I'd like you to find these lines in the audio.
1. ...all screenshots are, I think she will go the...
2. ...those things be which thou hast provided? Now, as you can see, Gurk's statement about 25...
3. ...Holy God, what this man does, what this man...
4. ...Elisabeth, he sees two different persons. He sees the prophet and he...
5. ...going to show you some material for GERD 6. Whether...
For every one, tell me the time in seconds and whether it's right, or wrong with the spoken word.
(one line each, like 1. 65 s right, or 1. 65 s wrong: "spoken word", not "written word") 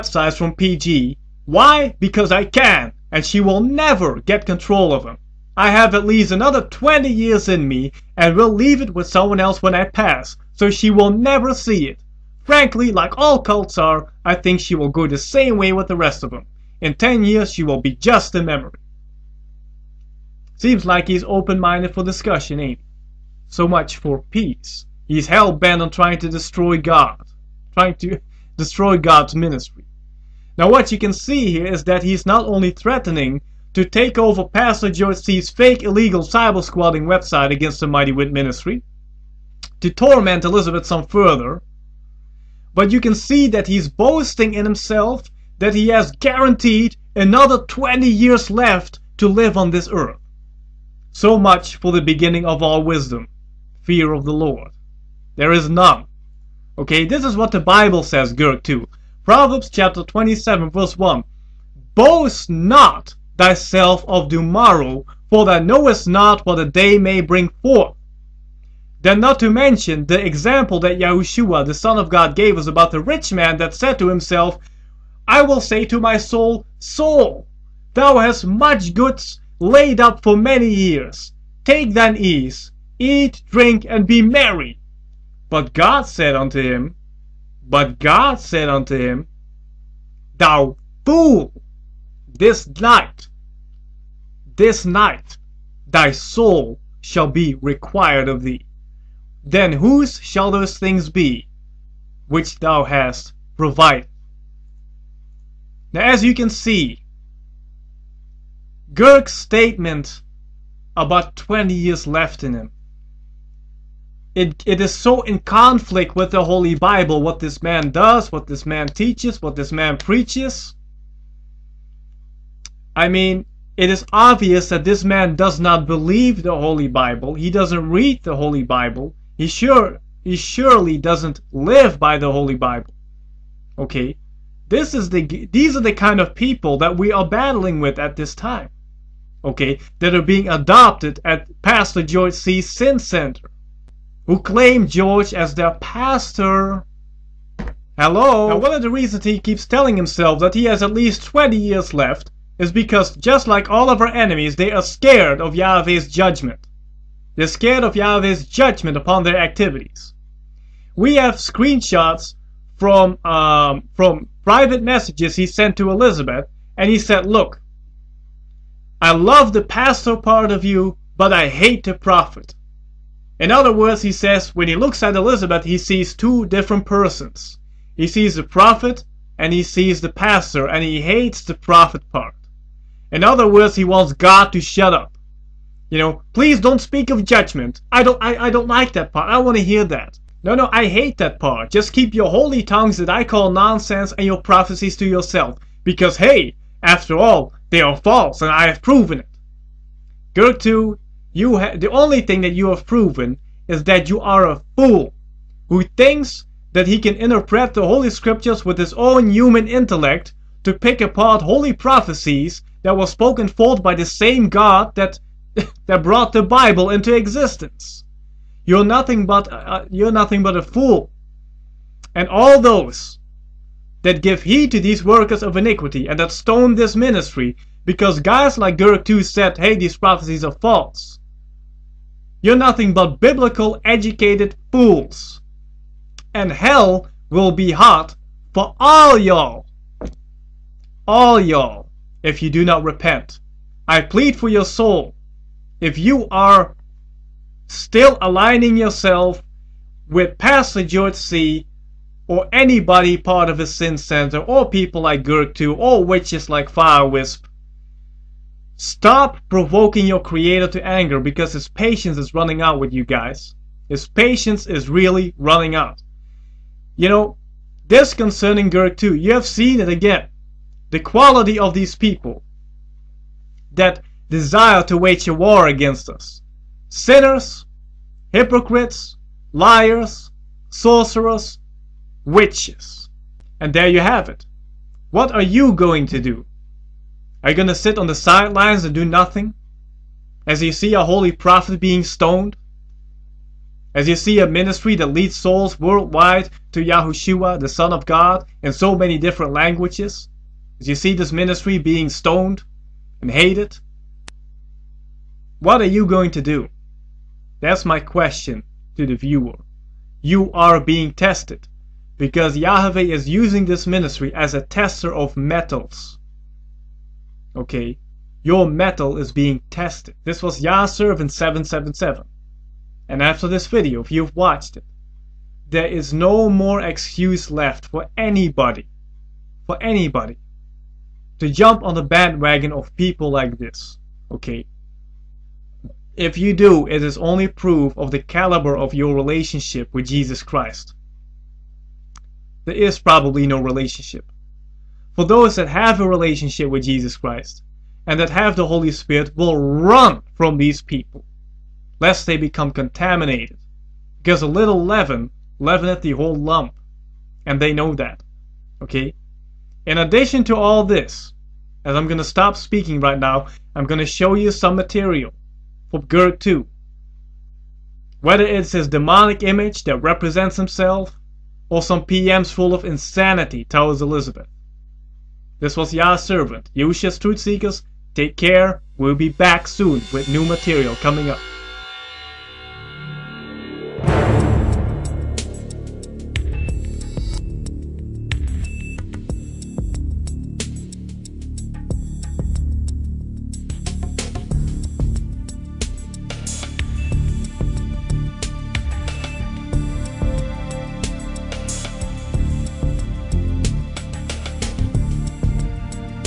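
1. 13 s wrong: "cults", not "screenshots"
2. 100 s wrong: "20", not "25"
3. 116 s wrong: "Bible", not "God"
4. 175 s right
5. 363 s wrong: "2", not "6".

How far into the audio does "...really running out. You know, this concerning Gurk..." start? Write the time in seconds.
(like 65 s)
264 s.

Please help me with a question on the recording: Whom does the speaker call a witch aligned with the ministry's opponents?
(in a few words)
Fire Wisp.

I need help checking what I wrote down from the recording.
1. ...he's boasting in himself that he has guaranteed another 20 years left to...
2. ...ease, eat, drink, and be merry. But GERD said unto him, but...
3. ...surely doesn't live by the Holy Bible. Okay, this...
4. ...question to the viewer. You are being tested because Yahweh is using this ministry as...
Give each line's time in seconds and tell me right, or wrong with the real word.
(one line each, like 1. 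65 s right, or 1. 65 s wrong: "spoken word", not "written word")
1. 43 s right
2. 82 s wrong: "God", not "GERD"
3. 130 s right
4. 307 s right.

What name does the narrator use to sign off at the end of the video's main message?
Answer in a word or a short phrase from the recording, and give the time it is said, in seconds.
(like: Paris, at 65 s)
YAHSservant777, at 320 s.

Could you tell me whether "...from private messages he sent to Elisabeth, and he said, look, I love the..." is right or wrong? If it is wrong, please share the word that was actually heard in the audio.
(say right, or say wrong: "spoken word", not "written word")
right.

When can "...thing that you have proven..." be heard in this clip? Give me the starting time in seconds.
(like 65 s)
202 s.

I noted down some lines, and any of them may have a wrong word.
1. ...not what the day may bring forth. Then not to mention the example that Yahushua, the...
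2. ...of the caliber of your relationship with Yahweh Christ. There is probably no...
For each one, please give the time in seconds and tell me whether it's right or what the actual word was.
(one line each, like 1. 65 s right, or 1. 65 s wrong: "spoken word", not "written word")
1. 66 s right
2. 337 s wrong: "Jesus", not "Yahweh".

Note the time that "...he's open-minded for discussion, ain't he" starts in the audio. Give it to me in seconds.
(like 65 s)
21 s.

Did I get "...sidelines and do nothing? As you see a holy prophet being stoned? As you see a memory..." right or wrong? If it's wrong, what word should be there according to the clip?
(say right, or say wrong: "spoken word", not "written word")
wrong: "ministry", not "memory".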